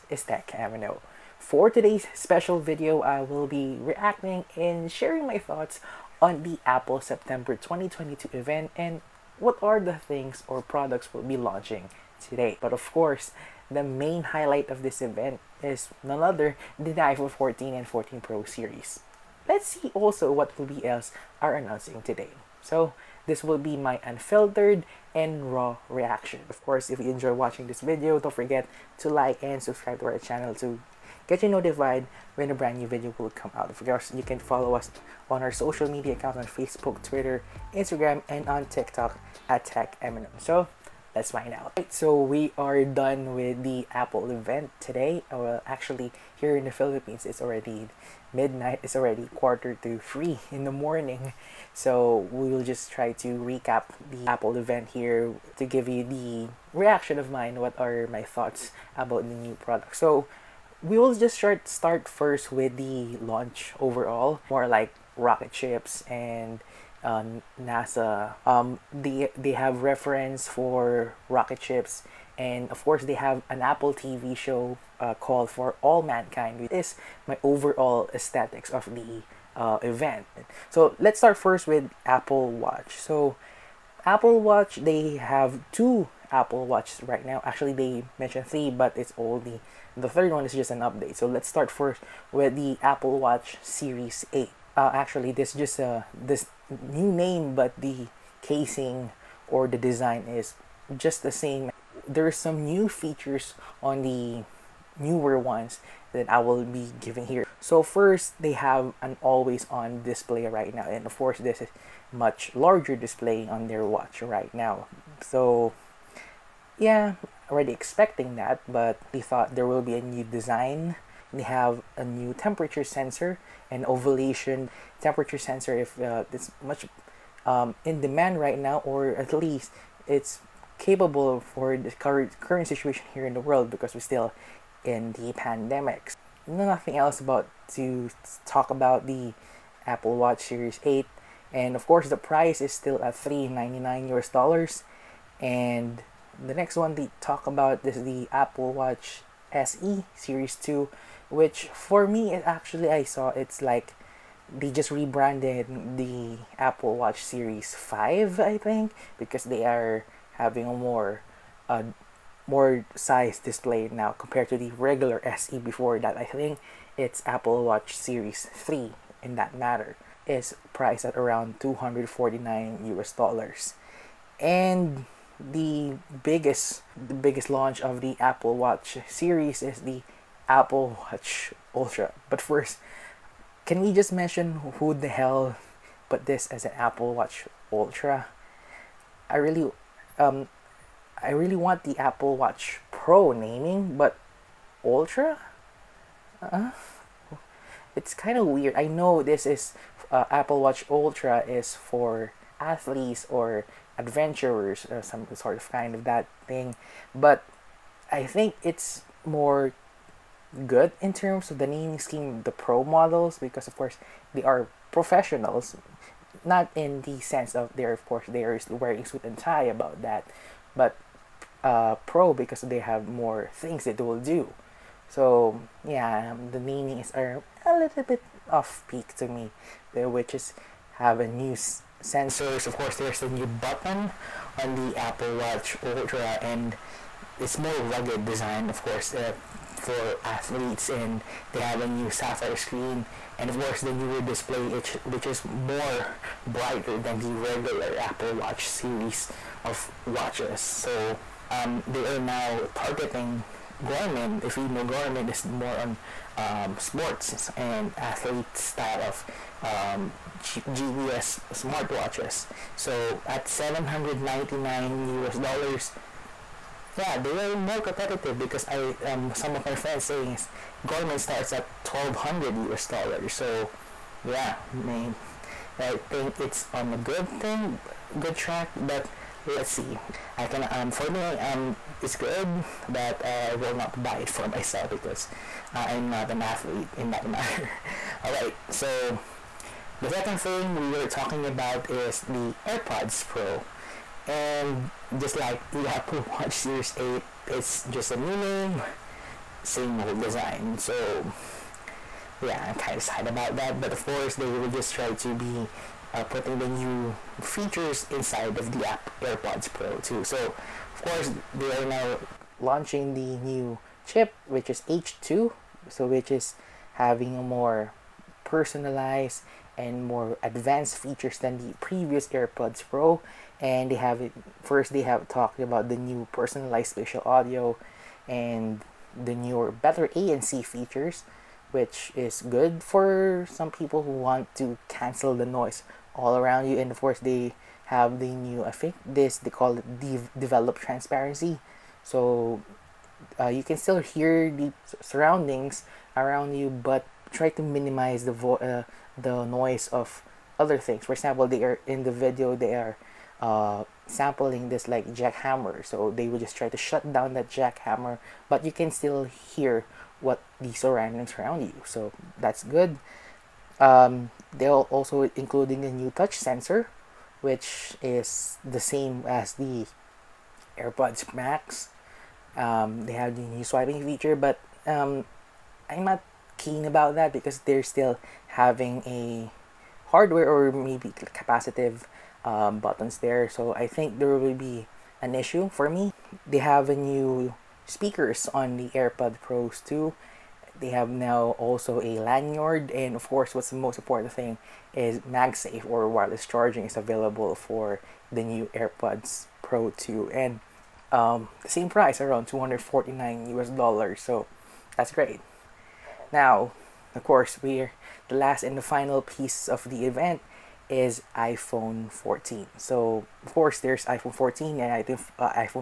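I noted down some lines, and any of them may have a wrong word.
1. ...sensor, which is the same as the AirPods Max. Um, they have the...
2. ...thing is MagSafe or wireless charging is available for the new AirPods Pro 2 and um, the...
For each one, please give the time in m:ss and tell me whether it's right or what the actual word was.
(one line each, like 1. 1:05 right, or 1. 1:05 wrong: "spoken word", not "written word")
1. 6:06 right
2. 6:34 right.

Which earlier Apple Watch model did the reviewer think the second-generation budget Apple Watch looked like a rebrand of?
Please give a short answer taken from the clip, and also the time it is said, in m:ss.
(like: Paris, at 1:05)
Apple Watch Series 5, at 2:36.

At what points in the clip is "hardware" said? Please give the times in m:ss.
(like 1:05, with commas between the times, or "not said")
6:20.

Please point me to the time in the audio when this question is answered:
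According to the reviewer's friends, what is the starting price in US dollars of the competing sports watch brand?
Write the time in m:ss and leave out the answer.
4:31.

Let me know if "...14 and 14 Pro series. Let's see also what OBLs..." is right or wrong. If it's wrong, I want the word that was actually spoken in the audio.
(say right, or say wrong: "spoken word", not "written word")
right.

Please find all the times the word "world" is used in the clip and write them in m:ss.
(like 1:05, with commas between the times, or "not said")
2:13.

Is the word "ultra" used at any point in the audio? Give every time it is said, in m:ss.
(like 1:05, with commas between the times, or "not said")
3:01, 3:07, 3:14, 3:20, 3:55.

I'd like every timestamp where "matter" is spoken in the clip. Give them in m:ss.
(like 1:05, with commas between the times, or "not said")
2:49, 4:47.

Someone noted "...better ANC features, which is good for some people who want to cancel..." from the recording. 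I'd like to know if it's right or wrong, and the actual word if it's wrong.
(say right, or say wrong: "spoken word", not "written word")
right.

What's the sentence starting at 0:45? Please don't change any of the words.
Uh, well, actually, here in the Philippines, it's already midnight.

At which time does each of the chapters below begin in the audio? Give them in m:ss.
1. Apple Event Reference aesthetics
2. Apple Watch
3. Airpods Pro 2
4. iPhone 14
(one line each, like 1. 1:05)
1. 0:43
2. 1:12
3. 4:49
4. 6:47.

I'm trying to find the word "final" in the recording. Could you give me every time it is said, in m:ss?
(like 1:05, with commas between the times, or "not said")
6:48.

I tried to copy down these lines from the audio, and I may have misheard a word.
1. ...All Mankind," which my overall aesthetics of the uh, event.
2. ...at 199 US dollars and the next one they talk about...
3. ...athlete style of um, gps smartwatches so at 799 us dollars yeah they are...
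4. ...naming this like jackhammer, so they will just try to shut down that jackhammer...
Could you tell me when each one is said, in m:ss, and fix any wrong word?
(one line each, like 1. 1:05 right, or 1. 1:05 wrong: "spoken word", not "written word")
1. 1:15 right
2. 2:23 wrong: "399", not "199"
3. 4:17 right
4. 5:54 wrong: "sampling", not "naming".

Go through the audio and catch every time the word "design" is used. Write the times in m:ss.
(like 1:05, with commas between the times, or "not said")
1:39, 2:00, 3:58, 5:00.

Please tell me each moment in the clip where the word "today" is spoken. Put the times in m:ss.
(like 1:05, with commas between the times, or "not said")
0:01, 0:12, 0:22, 0:44.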